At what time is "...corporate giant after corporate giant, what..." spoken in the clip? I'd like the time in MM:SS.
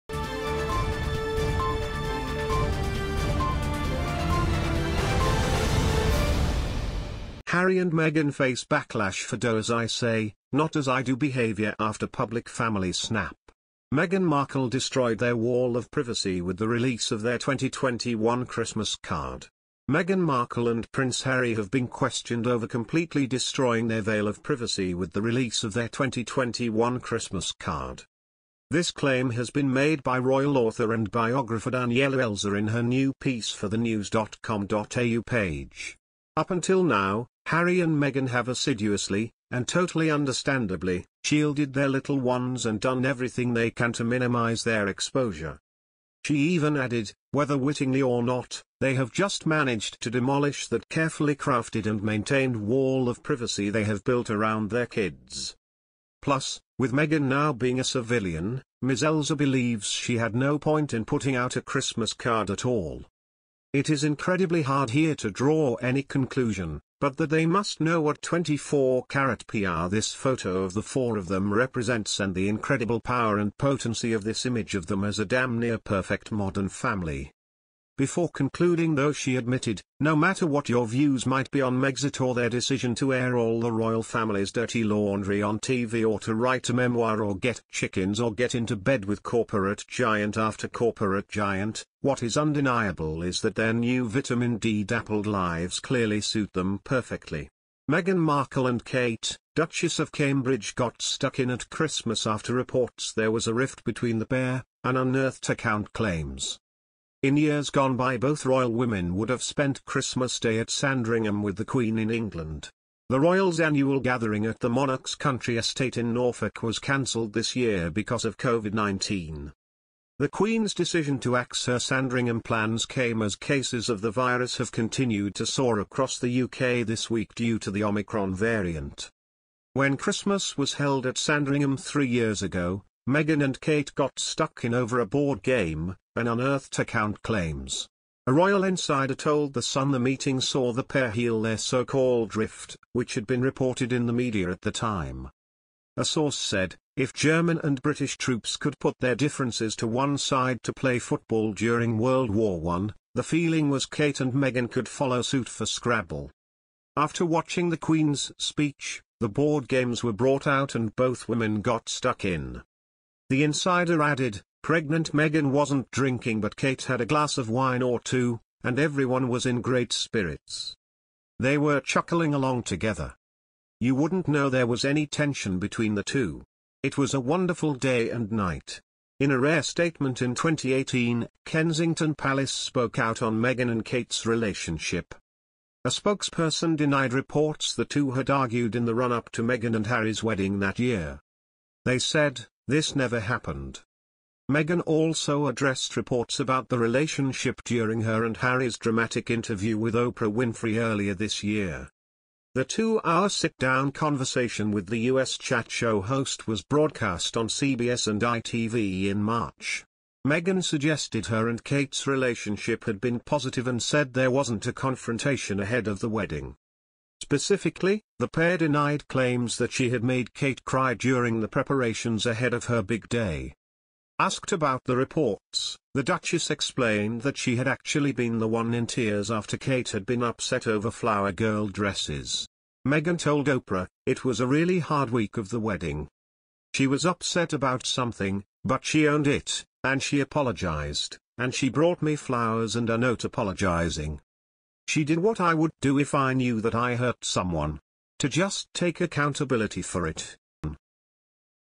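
01:29.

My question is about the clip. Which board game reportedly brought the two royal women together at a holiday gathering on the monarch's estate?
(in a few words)
Scrabble.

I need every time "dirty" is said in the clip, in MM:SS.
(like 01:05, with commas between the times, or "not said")
01:24.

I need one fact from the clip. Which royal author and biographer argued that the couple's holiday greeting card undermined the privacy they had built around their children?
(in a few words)
Danielle Elser.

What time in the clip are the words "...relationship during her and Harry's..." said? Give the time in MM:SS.
03:16.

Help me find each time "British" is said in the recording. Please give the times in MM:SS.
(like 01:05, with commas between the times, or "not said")
02:27.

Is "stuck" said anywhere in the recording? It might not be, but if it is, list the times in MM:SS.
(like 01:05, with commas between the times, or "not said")
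01:41, 02:14, 02:41.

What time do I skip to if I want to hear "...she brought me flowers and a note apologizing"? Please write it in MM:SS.
04:01.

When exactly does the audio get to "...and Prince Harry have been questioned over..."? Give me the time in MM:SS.
00:20.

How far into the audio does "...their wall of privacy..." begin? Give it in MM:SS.
00:15.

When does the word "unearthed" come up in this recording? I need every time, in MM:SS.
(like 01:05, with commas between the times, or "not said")
01:44, 02:16.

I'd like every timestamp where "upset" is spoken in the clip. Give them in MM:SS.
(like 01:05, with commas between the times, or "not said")
03:50, 03:57.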